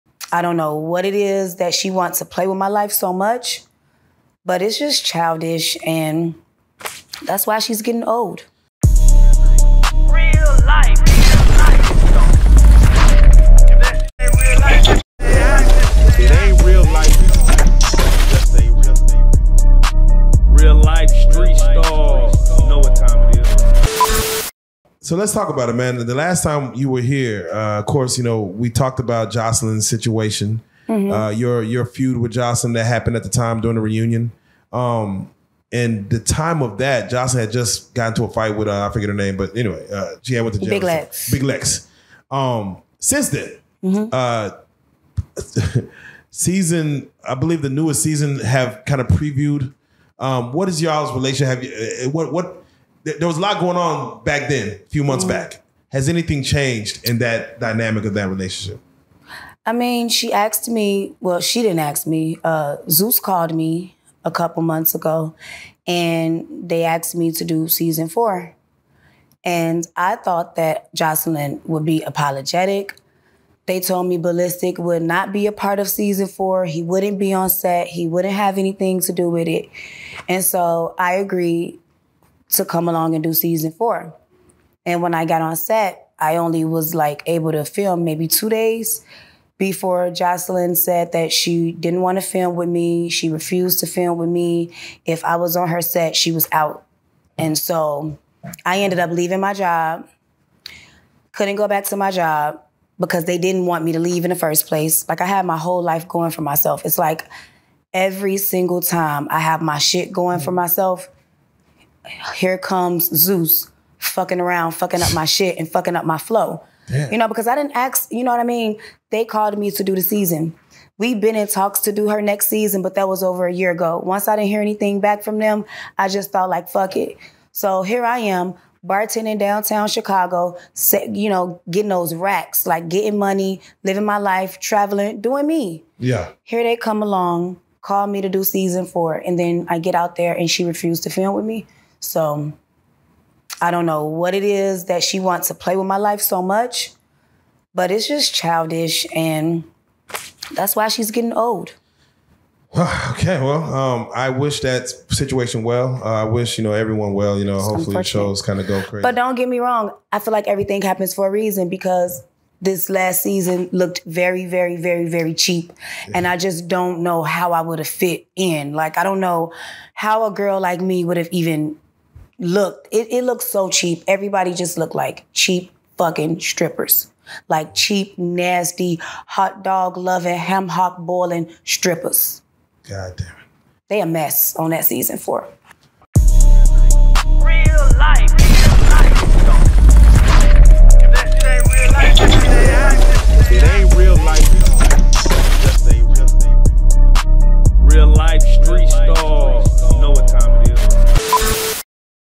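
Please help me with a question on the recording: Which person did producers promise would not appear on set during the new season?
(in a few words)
Ballistic.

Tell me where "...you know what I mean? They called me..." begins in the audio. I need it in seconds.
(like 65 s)
118 s.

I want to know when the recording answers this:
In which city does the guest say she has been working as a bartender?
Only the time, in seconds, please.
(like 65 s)
129 s.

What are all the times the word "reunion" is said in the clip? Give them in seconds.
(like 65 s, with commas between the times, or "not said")
33 s.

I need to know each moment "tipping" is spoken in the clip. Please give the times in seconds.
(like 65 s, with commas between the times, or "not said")
not said.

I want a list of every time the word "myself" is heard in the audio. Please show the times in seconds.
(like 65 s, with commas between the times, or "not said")
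106 s, 110 s.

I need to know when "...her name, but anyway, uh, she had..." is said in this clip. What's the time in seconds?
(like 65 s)
39 s.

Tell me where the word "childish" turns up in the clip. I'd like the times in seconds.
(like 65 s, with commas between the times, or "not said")
5 s, 148 s.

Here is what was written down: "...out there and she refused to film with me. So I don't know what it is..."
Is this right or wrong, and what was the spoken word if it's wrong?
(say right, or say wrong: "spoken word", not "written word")
right.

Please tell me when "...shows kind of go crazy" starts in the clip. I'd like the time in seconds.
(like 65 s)
158 s.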